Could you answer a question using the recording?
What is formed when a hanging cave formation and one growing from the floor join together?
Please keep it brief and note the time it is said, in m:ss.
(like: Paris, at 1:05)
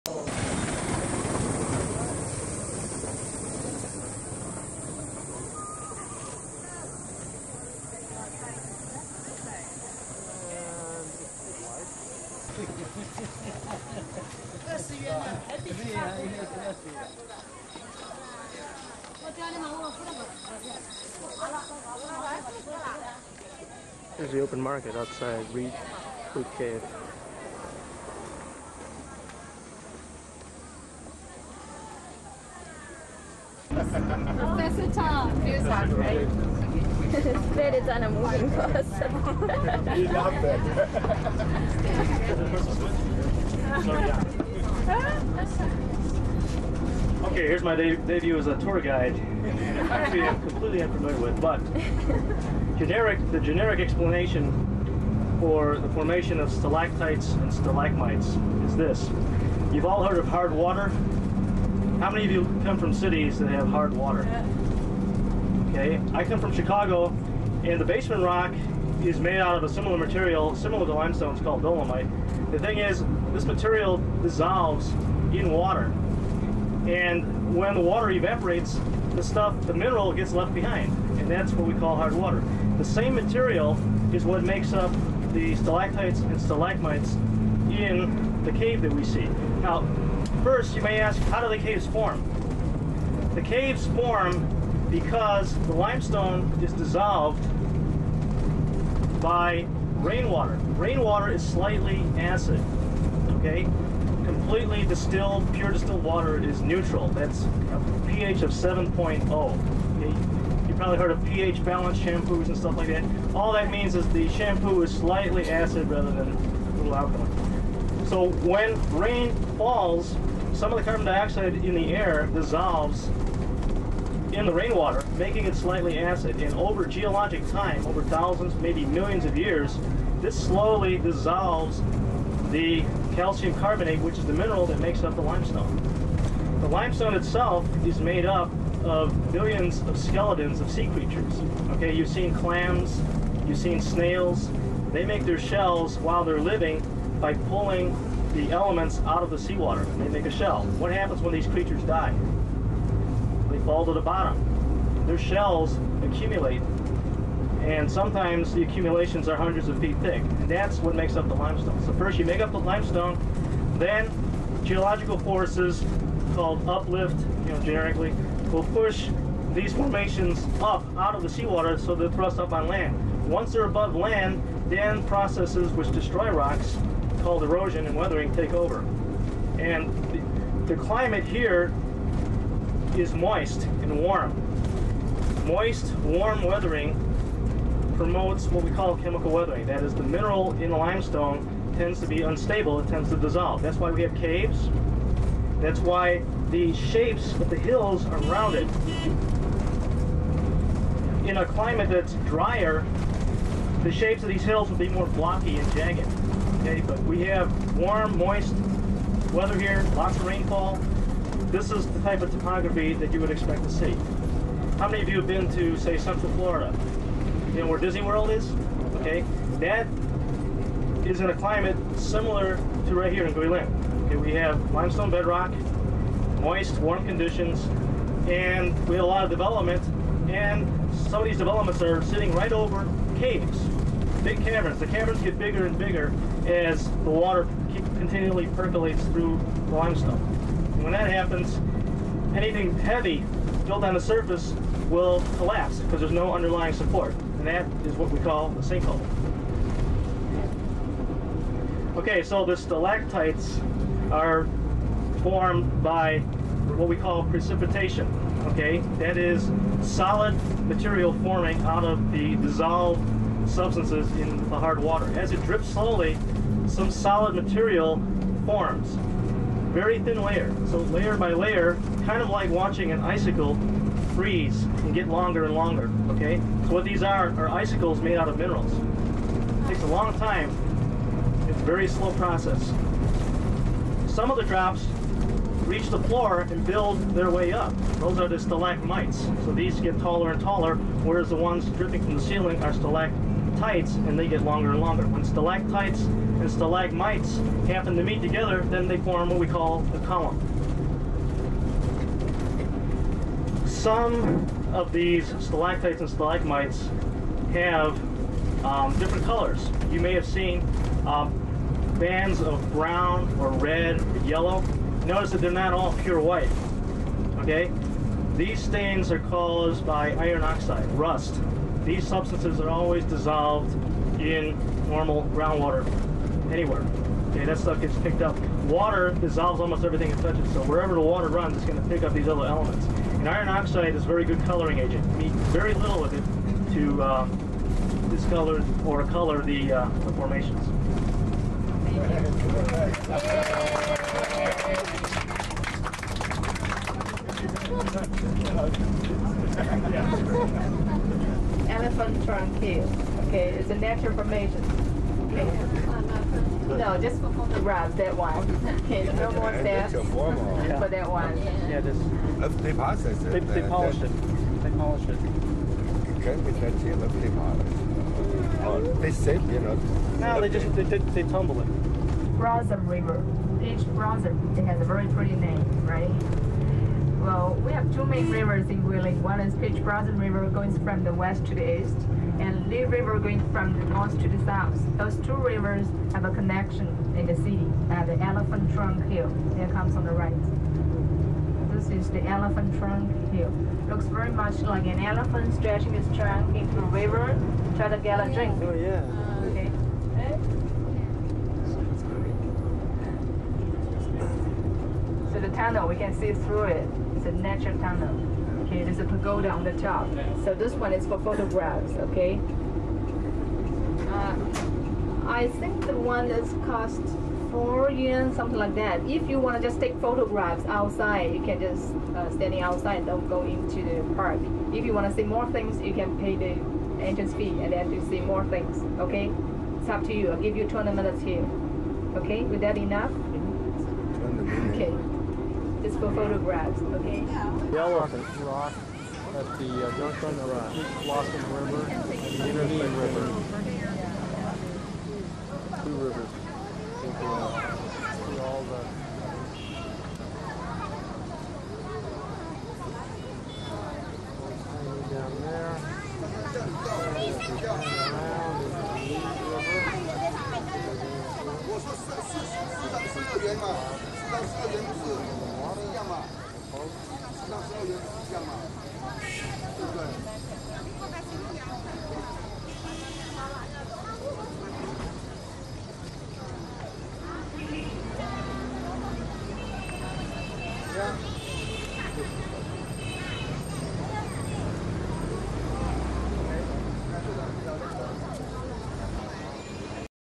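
a column, at 4:59.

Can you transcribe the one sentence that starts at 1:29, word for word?
Now, first you may ask, how do the caves form?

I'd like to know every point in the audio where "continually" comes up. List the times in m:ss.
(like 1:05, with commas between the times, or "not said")
3:57.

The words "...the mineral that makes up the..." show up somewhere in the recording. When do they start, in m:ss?
2:14.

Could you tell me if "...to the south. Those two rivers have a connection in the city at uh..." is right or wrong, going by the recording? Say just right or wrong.
right.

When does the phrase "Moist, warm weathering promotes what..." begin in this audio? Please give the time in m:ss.
3:05.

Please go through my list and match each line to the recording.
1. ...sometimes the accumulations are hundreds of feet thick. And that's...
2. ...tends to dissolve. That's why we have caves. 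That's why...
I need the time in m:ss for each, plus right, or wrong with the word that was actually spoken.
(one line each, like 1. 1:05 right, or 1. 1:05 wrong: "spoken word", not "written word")
1. 2:37 right
2. 3:12 right.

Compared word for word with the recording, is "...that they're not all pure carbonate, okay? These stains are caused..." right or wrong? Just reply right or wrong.
wrong.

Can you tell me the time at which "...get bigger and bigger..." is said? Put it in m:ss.
3:55.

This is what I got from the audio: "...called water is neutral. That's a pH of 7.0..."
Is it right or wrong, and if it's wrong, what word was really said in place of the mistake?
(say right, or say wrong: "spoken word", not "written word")
wrong: "distilled", not "called".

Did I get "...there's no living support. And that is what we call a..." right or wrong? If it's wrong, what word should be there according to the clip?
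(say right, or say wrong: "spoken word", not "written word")
wrong: "underlying", not "living".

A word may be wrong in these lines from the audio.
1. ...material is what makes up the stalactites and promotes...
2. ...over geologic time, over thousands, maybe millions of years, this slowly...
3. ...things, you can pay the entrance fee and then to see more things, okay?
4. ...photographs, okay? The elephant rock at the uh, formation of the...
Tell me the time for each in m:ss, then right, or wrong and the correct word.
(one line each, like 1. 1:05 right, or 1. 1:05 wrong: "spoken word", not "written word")
1. 1:23 wrong: "stalagmites", not "promotes"
2. 2:06 right
3. 7:05 right
4. 7:16 wrong: "junction", not "formation".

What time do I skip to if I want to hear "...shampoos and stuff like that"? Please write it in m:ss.
1:51.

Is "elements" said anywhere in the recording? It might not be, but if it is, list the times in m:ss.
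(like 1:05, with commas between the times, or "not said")
2:28, 5:32.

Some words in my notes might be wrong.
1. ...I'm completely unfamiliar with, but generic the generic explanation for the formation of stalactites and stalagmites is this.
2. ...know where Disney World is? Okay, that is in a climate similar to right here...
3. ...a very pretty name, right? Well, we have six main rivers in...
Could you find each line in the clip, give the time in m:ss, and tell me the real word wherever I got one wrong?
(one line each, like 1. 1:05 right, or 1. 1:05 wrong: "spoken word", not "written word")
1. 0:50 right
2. 3:37 right
3. 6:14 wrong: "two", not "six".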